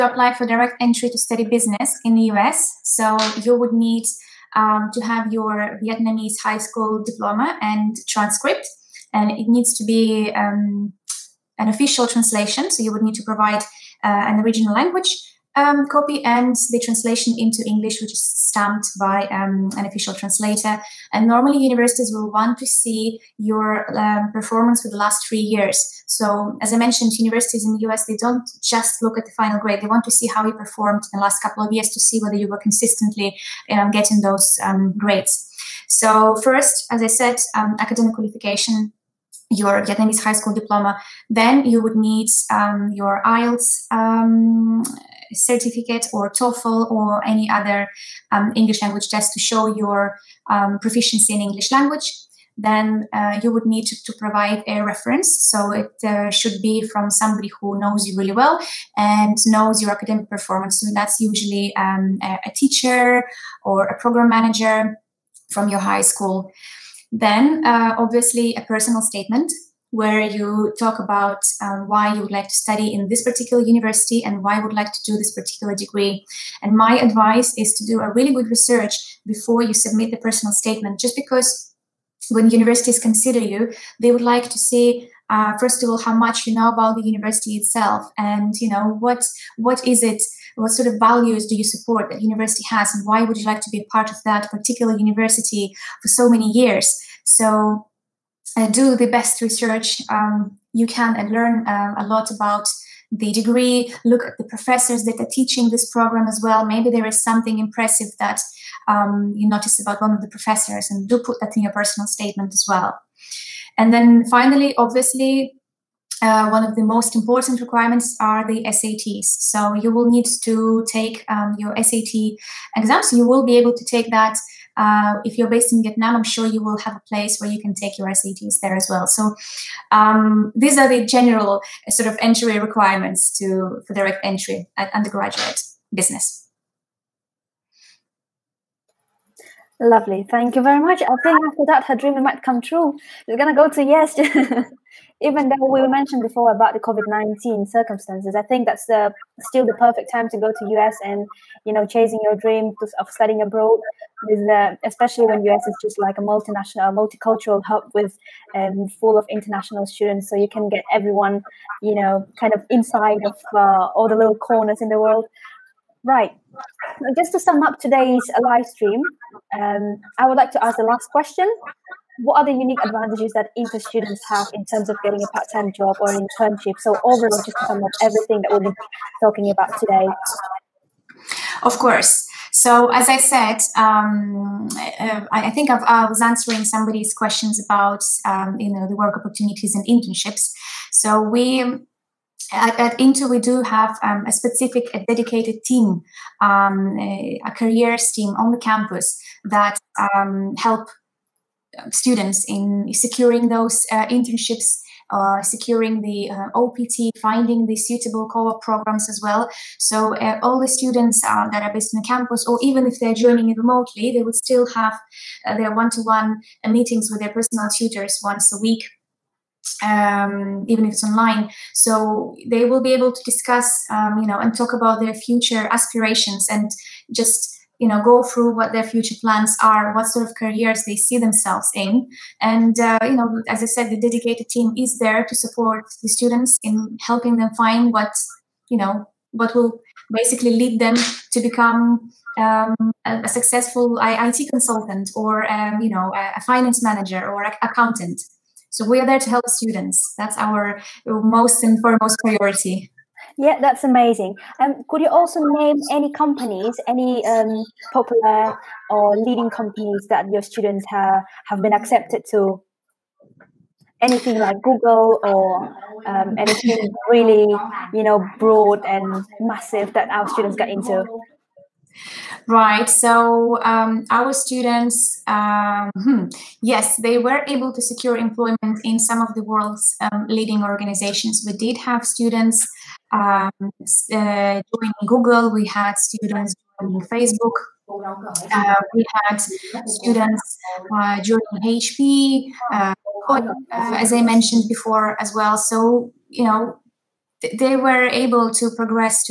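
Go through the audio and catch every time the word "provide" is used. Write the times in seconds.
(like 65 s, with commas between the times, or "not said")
13 s, 54 s.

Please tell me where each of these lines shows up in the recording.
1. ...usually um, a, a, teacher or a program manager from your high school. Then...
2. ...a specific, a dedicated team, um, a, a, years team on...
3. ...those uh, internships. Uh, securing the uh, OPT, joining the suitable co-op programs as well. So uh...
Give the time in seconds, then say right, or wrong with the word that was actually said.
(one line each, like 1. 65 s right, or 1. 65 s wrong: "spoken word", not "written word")
1. 61 s right
2. 194 s wrong: "careers", not "years"
3. 203 s wrong: "finding", not "joining".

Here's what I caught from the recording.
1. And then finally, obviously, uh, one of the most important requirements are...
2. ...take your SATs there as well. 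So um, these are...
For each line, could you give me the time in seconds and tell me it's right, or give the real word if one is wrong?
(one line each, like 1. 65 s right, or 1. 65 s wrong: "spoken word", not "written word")
1. 113 s right
2. 127 s right.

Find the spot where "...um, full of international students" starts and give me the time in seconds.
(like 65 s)
158 s.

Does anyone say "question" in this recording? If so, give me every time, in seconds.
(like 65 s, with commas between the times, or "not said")
171 s, 187 s.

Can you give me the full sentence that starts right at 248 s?
So we are there to help students.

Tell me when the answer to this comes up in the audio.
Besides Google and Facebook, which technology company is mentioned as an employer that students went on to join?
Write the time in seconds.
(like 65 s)
291 s.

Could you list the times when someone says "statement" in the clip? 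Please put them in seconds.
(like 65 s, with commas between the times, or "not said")
68 s, 80 s, 112 s.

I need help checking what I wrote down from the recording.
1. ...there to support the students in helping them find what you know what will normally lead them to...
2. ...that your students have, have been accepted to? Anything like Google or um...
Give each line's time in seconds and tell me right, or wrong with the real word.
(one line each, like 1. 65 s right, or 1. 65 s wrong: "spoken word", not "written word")
1. 234 s wrong: "basically", not "normally"
2. 260 s right.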